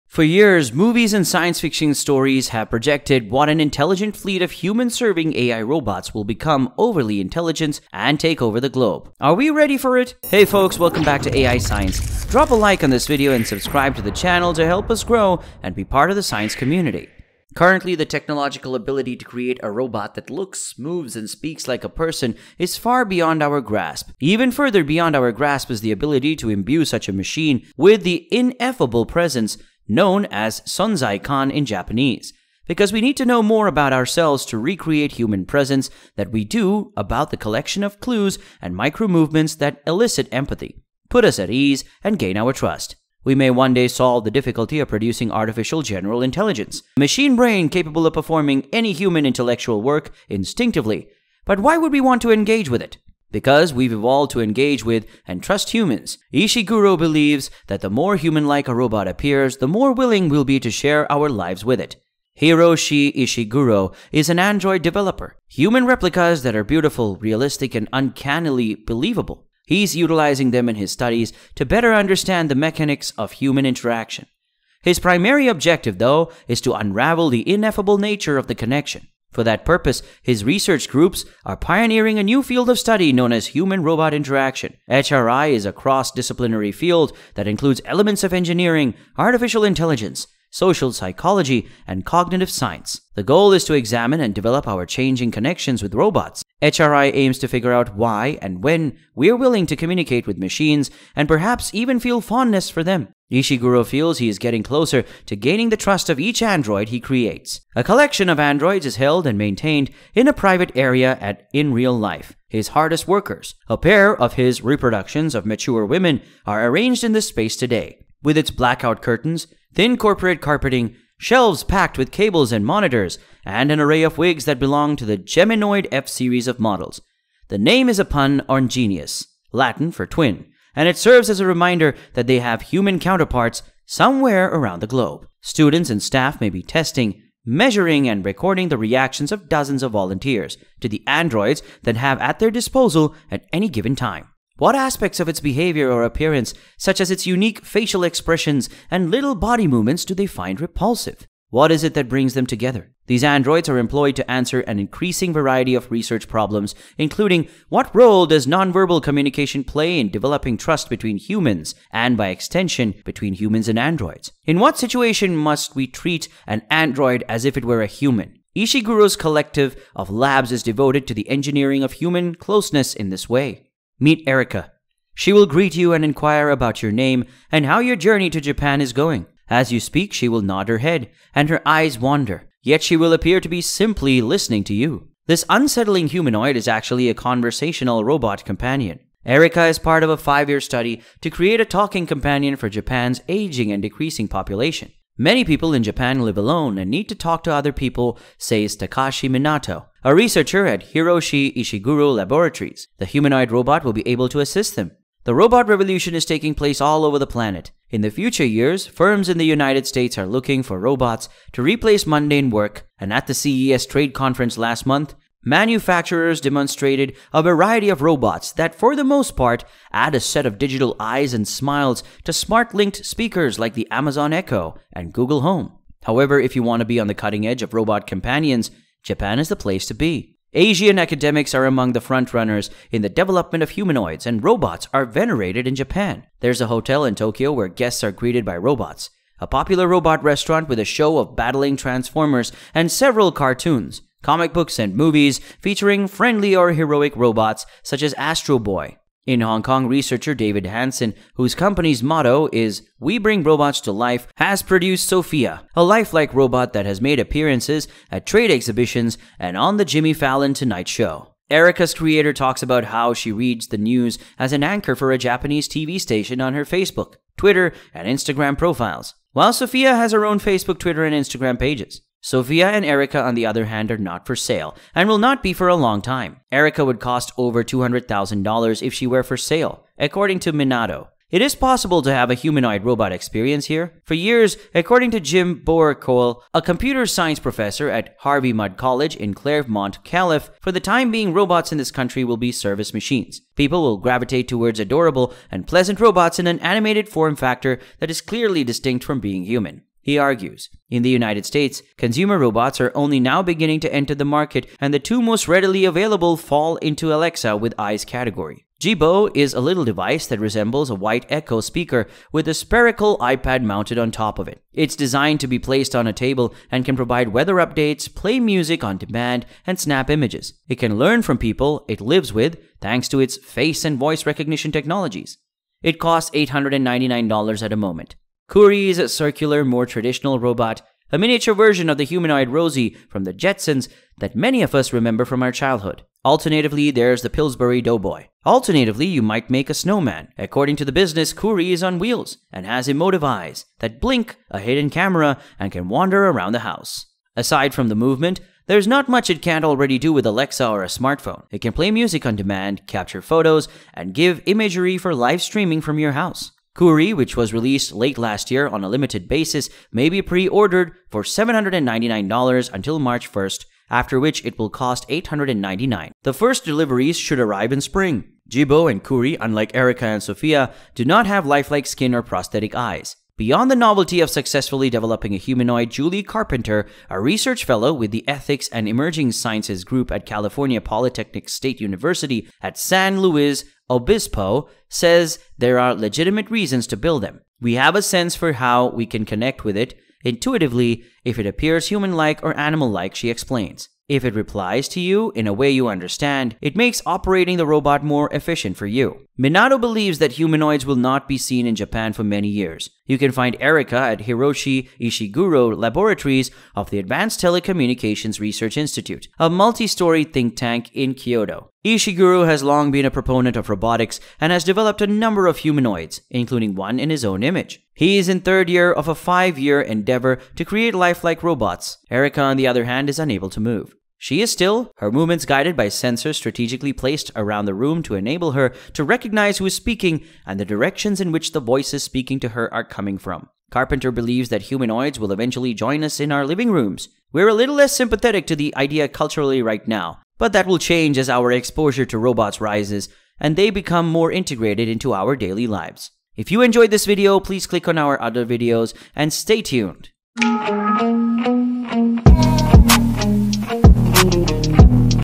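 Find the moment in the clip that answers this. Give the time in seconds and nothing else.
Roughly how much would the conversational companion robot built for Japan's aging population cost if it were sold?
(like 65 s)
277 s.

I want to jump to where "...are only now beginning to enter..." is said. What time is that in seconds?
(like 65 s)
302 s.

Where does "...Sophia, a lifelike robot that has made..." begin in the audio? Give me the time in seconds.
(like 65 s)
255 s.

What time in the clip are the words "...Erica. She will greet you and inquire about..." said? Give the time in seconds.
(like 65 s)
174 s.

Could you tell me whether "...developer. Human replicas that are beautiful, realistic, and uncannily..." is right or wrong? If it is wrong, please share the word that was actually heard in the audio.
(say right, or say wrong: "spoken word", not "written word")
right.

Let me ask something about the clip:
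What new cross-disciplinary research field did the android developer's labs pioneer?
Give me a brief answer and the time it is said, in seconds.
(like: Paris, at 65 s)
human robot interaction, at 83 s.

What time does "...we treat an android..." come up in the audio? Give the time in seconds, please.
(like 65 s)
165 s.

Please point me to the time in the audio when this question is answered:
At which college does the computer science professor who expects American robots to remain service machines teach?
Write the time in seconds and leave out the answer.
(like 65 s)
288 s.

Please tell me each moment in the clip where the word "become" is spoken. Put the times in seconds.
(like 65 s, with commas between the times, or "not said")
6 s, 443 s.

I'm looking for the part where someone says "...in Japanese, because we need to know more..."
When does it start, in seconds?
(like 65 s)
31 s.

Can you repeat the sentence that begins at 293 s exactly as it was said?
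People will gravitate towards adorable and pleasant robots in an animated form factor that is clearly distinct from being human.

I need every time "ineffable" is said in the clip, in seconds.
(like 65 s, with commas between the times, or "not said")
28 s, 77 s.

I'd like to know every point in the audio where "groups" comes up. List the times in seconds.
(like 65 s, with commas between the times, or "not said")
80 s, 379 s.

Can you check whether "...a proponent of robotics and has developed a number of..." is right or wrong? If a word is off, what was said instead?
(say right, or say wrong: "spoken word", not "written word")
right.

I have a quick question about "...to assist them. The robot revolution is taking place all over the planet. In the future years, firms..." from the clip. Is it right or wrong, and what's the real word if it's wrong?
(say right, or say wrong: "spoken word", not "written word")
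right.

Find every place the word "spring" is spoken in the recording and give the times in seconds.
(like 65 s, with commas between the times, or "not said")
367 s.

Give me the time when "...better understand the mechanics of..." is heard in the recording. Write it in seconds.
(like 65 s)
71 s.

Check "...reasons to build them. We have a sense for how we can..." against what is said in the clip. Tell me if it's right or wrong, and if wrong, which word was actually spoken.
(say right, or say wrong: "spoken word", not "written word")
right.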